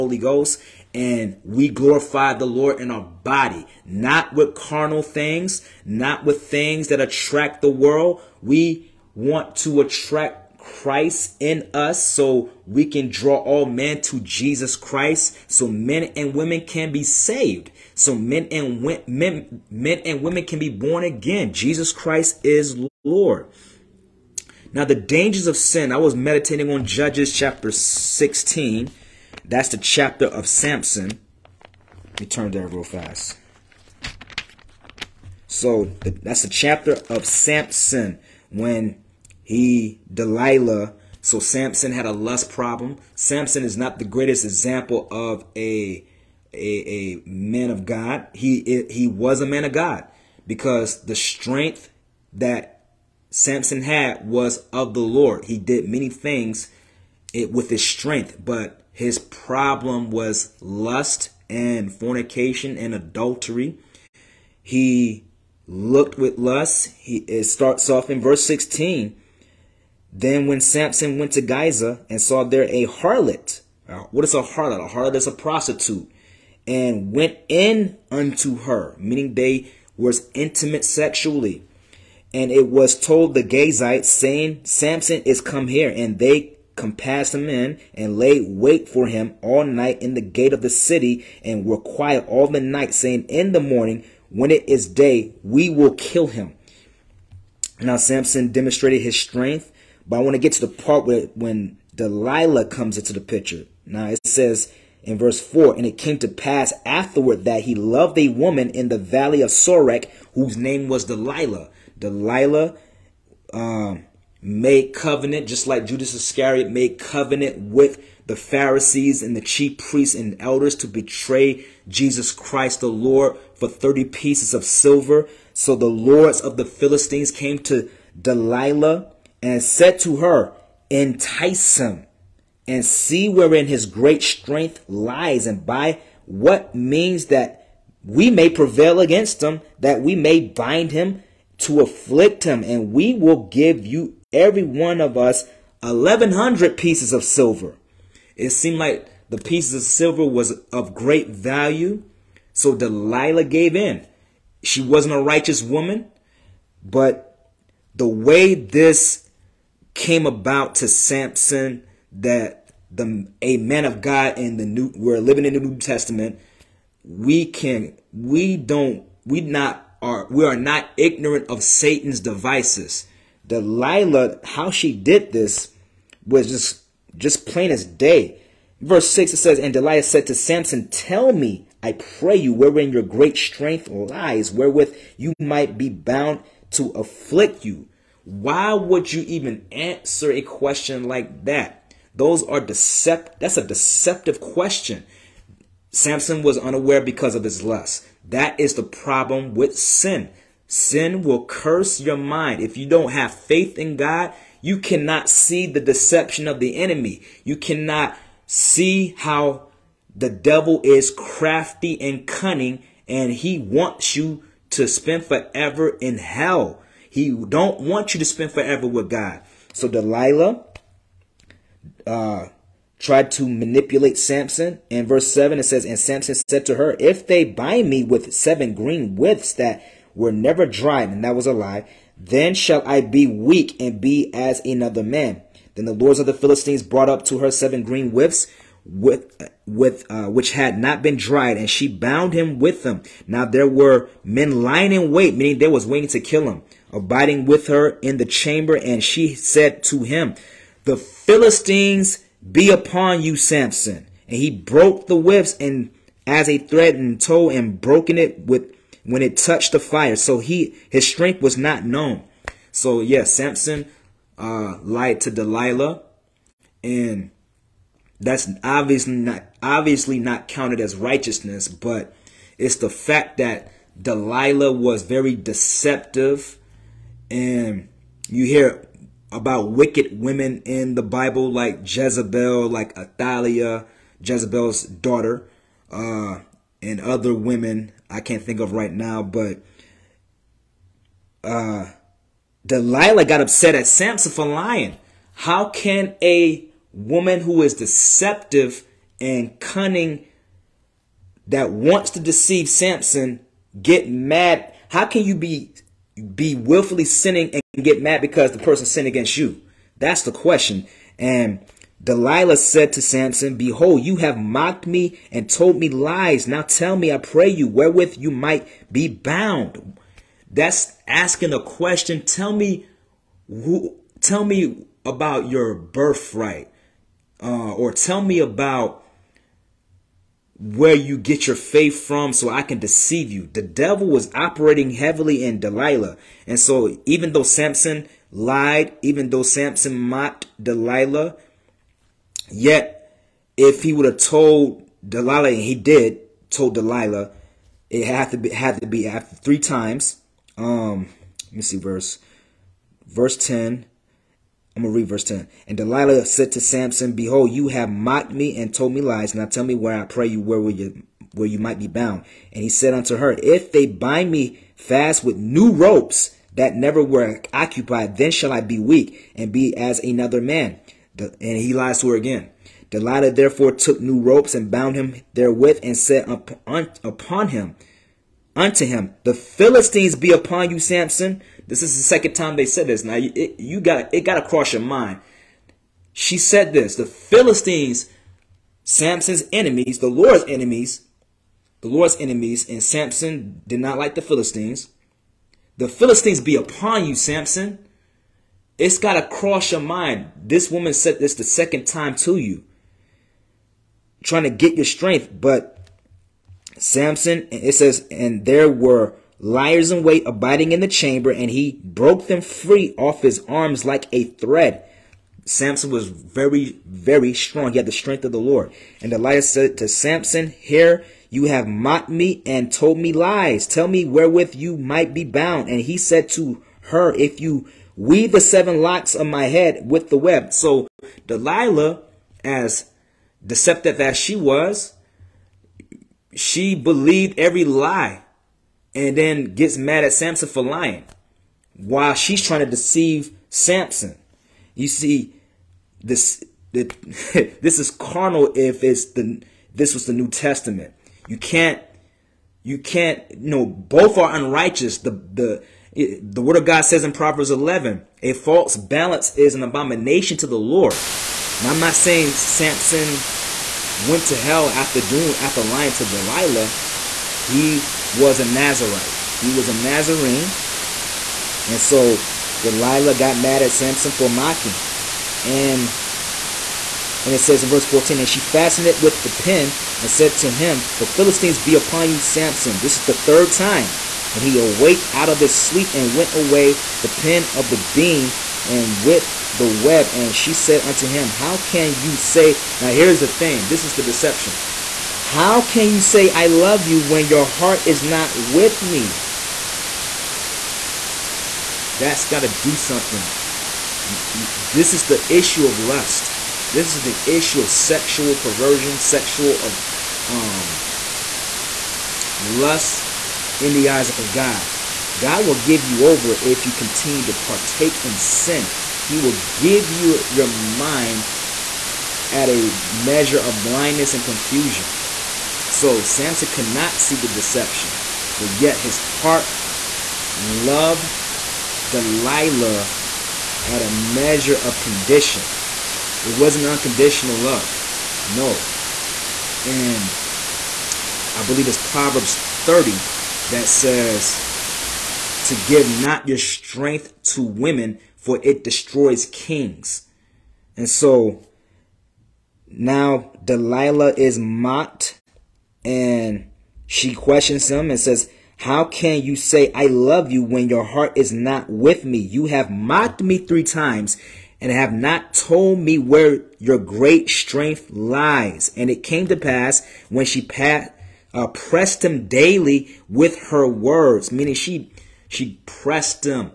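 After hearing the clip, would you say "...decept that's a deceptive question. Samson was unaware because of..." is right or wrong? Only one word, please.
right.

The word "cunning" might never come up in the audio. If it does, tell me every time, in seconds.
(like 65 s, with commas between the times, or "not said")
212 s, 299 s.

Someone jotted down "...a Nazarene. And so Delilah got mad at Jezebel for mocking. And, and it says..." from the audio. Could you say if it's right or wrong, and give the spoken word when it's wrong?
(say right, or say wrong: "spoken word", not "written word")
wrong: "Samson", not "Jezebel".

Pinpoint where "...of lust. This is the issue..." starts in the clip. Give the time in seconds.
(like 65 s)
505 s.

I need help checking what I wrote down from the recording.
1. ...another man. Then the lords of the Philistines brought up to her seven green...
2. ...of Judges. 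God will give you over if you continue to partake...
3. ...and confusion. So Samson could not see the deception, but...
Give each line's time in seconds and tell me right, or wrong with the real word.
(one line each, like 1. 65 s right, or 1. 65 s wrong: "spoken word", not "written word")
1. 234 s right
2. 514 s wrong: "God", not "Judges"
3. 524 s right.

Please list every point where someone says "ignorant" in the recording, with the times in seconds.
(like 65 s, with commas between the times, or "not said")
170 s.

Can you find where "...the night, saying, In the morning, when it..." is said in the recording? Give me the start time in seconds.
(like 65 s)
92 s.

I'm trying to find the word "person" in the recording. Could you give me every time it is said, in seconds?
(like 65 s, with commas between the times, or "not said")
308 s.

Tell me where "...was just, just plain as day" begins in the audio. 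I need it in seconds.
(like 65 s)
176 s.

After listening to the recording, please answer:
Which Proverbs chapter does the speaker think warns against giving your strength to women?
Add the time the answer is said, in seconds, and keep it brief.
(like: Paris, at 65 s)
Proverbs 30, at 541 s.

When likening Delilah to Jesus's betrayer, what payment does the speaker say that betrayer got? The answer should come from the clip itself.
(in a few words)
30 pieces of silver.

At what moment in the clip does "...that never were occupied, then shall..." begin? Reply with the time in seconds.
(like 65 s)
366 s.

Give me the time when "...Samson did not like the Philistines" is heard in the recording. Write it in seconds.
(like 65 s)
392 s.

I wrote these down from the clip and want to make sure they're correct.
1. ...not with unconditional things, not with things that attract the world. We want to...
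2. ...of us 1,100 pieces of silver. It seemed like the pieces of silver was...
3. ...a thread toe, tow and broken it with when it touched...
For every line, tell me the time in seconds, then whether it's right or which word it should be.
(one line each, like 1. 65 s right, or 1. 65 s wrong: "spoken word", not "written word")
1. 3 s wrong: "carnal", not "unconditional"
2. 145 s right
3. 256 s right.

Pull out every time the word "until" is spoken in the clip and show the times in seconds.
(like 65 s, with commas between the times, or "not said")
not said.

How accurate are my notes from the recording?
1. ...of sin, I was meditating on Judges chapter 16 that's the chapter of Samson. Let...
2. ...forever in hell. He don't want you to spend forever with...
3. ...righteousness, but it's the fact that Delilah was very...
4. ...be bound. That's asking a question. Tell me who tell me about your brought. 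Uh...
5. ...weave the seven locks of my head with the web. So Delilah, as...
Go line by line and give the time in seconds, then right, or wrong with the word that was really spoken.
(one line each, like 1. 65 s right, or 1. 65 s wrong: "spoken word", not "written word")
1. 25 s right
2. 215 s right
3. 270 s right
4. 318 s wrong: "birthright", not "brought"
5. 427 s right.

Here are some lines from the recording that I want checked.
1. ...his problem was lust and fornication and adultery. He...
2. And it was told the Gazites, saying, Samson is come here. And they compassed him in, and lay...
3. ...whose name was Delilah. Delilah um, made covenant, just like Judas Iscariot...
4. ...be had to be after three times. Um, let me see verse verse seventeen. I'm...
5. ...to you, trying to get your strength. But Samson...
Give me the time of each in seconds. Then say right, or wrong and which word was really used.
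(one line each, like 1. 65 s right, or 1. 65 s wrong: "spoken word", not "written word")
1. 58 s right
2. 82 s right
3. 110 s right
4. 348 s wrong: "ten", not "seventeen"
5. 402 s right.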